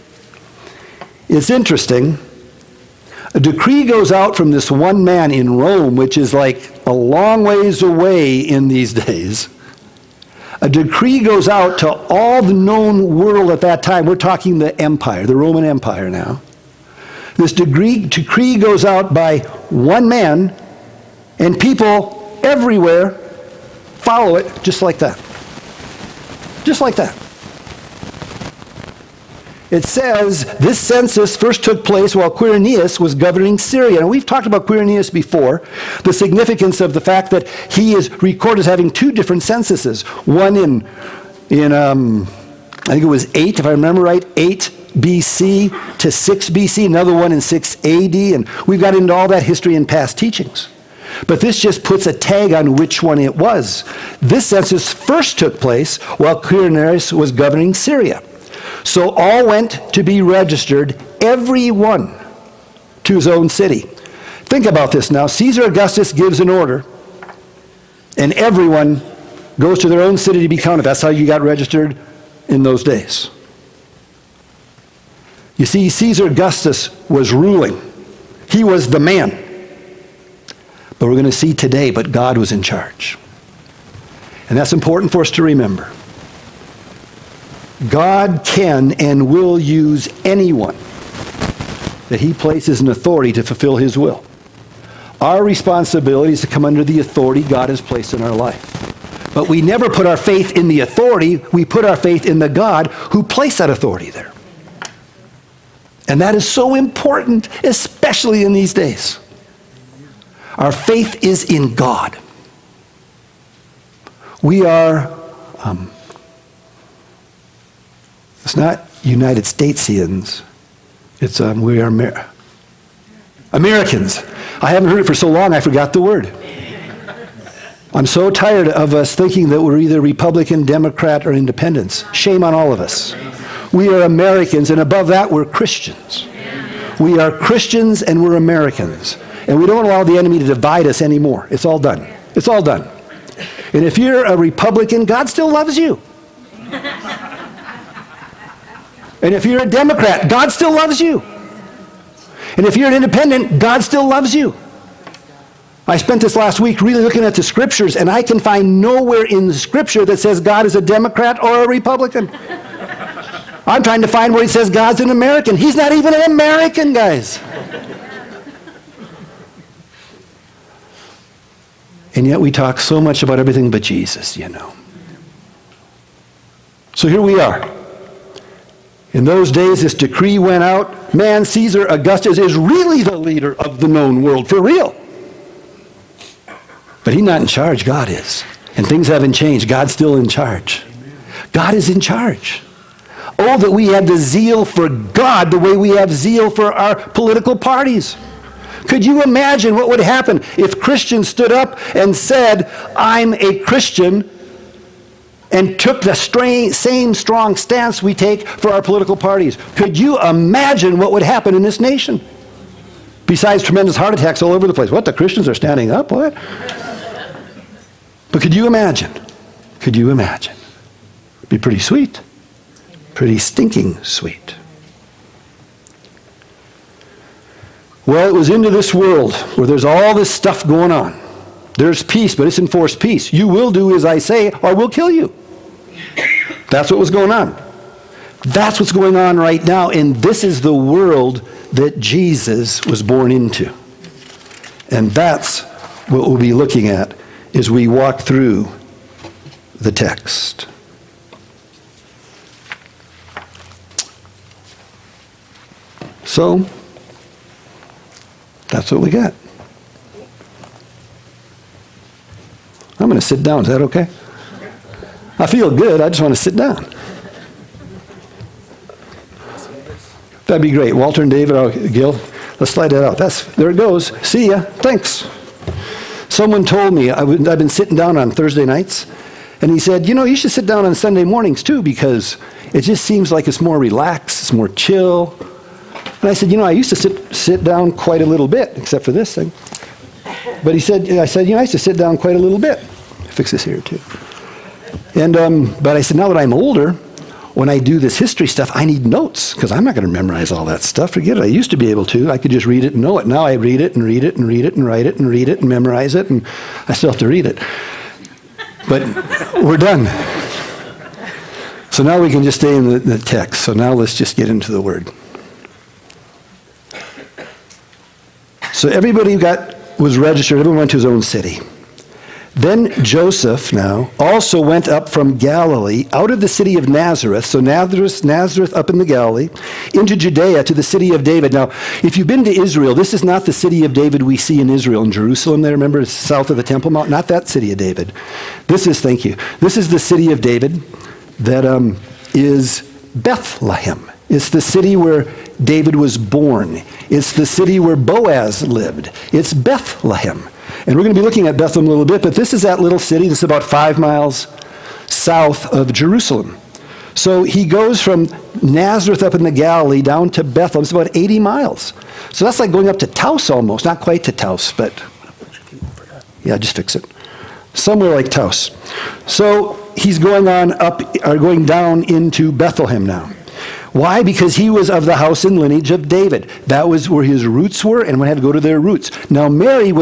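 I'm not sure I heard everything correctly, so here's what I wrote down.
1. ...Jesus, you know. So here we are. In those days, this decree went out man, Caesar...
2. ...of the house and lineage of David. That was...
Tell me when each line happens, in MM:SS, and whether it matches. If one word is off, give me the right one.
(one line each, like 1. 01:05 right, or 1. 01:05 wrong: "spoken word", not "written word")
1. 02:53 right
2. 06:14 right.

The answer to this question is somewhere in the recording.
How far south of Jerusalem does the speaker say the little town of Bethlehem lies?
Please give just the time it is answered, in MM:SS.
05:53.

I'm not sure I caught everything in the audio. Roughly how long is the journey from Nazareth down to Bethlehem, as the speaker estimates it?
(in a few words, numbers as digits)
80 miles.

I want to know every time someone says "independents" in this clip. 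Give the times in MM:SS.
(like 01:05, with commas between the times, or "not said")
02:11, 02:32.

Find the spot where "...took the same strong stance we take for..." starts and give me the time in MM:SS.
03:25.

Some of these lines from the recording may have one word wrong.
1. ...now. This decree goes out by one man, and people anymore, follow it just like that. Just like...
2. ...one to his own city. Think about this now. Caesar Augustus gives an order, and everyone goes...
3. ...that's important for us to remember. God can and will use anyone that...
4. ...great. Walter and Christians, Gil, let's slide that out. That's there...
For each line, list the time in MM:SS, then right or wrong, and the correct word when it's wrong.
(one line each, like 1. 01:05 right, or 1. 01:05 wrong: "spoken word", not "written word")
1. 00:16 wrong: "everywhere", not "anymore"
2. 01:01 right
3. 01:24 right
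4. 04:30 wrong: "David", not "Christians".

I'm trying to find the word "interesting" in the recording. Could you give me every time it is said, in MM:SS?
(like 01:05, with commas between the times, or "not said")
00:01.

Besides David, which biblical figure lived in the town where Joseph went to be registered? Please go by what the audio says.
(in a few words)
Boaz.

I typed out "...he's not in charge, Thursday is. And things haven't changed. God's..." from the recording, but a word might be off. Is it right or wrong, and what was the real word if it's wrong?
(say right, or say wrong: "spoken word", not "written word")
wrong: "God", not "Thursday".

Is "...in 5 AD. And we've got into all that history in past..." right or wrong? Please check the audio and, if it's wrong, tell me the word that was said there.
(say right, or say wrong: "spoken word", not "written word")
wrong: "6", not "5".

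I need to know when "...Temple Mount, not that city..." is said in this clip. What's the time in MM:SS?
05:36.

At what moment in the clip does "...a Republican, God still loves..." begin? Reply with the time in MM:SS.
02:24.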